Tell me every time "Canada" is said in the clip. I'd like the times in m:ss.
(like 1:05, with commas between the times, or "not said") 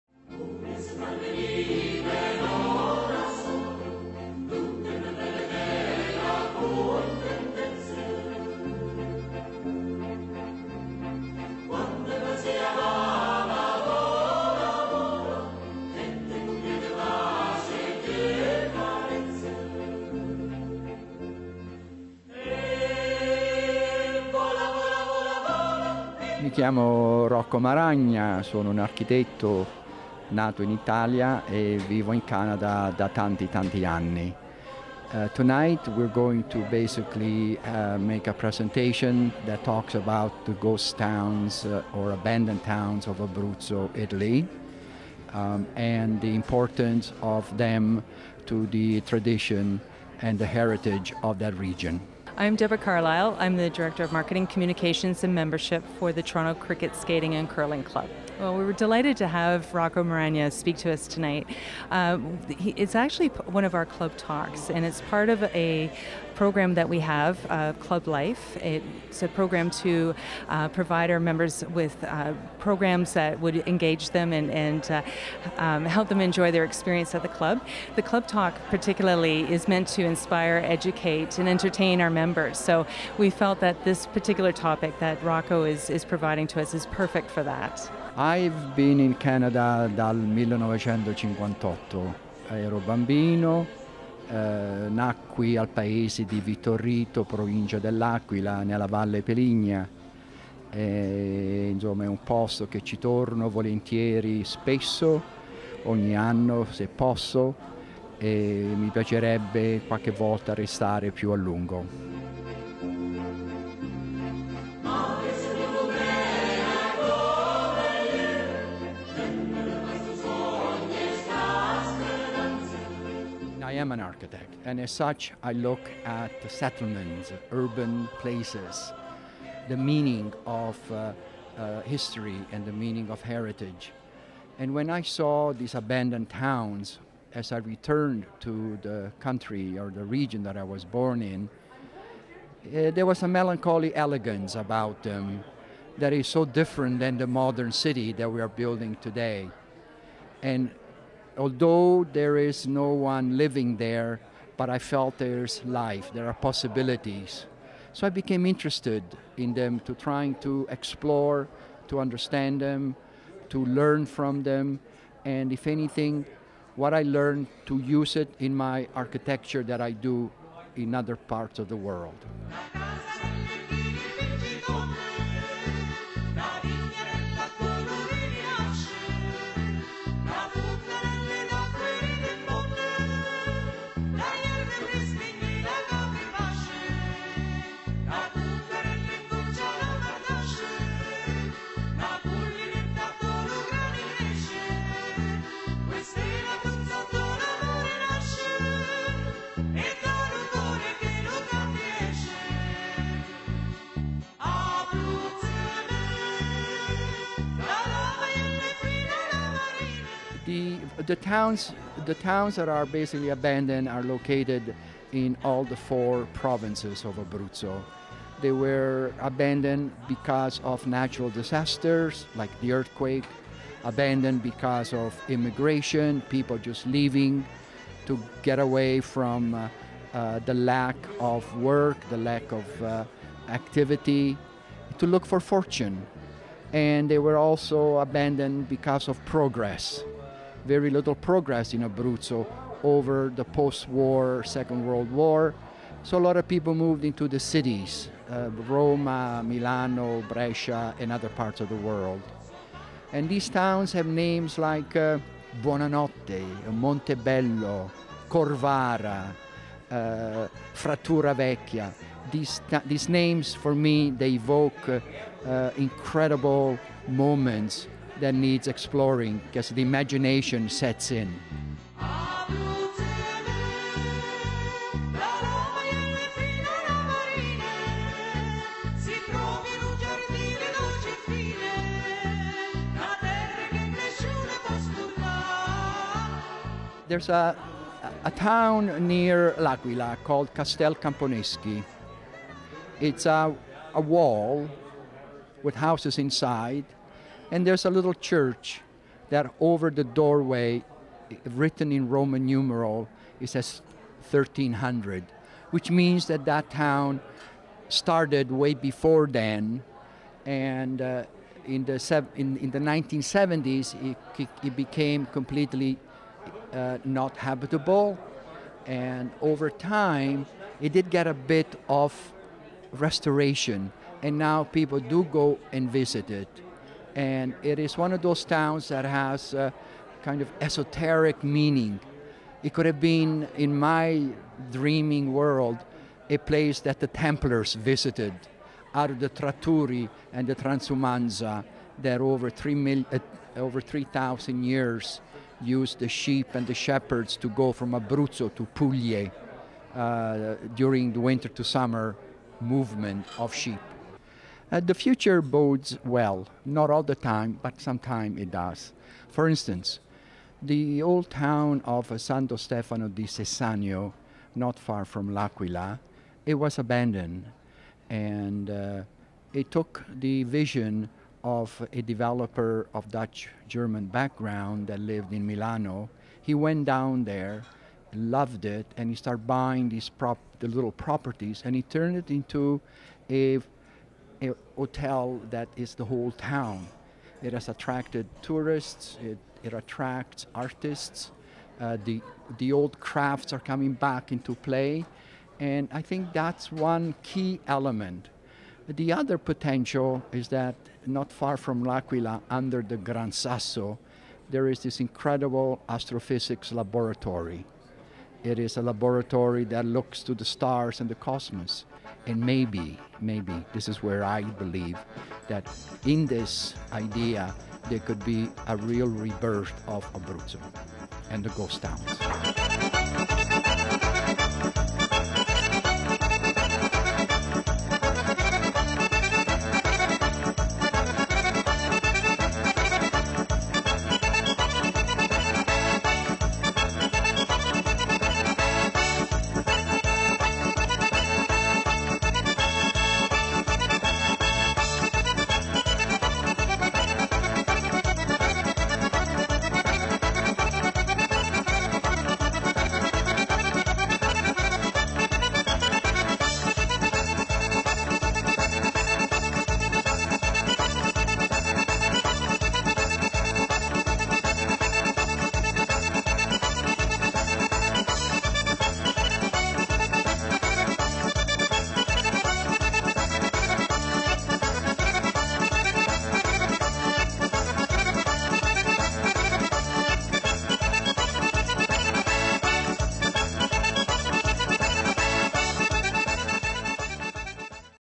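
0:32, 1:29.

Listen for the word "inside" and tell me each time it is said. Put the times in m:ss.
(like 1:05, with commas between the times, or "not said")
4:56.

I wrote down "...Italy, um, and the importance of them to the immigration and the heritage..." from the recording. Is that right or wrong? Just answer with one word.
wrong.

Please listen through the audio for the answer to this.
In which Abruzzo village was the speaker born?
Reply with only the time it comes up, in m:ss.
1:36.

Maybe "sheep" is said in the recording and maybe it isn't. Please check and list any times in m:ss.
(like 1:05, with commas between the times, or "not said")
5:46, 5:53.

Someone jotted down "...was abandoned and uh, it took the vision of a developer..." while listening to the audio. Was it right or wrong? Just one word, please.
right.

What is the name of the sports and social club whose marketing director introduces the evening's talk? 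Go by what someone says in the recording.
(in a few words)
Toronto Cricket Skating and Curling Club.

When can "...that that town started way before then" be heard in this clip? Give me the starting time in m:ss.
5:06.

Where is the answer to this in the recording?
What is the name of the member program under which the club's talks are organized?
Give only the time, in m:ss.
1:07.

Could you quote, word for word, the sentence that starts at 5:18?
And over time, it did get a bit of restoration.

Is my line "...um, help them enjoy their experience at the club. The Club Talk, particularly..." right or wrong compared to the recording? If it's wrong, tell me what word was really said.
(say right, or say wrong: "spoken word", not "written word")
right.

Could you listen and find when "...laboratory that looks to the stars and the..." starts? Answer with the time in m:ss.
6:48.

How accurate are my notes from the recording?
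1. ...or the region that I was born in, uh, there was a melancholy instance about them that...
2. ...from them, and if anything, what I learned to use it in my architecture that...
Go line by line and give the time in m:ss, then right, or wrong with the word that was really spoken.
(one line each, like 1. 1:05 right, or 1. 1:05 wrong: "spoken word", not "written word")
1. 2:19 wrong: "elegance", not "instance"
2. 2:44 right.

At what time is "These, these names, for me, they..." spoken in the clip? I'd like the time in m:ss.
4:22.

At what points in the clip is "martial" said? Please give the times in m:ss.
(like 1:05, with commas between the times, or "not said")
not said.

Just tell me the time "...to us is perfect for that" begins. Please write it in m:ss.
1:26.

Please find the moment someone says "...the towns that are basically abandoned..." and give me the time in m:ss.
3:32.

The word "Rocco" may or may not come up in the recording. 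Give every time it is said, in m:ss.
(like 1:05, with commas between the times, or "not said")
0:59, 1:25.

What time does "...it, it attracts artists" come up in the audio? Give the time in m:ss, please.
6:29.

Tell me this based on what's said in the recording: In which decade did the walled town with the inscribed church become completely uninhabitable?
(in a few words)
1970s.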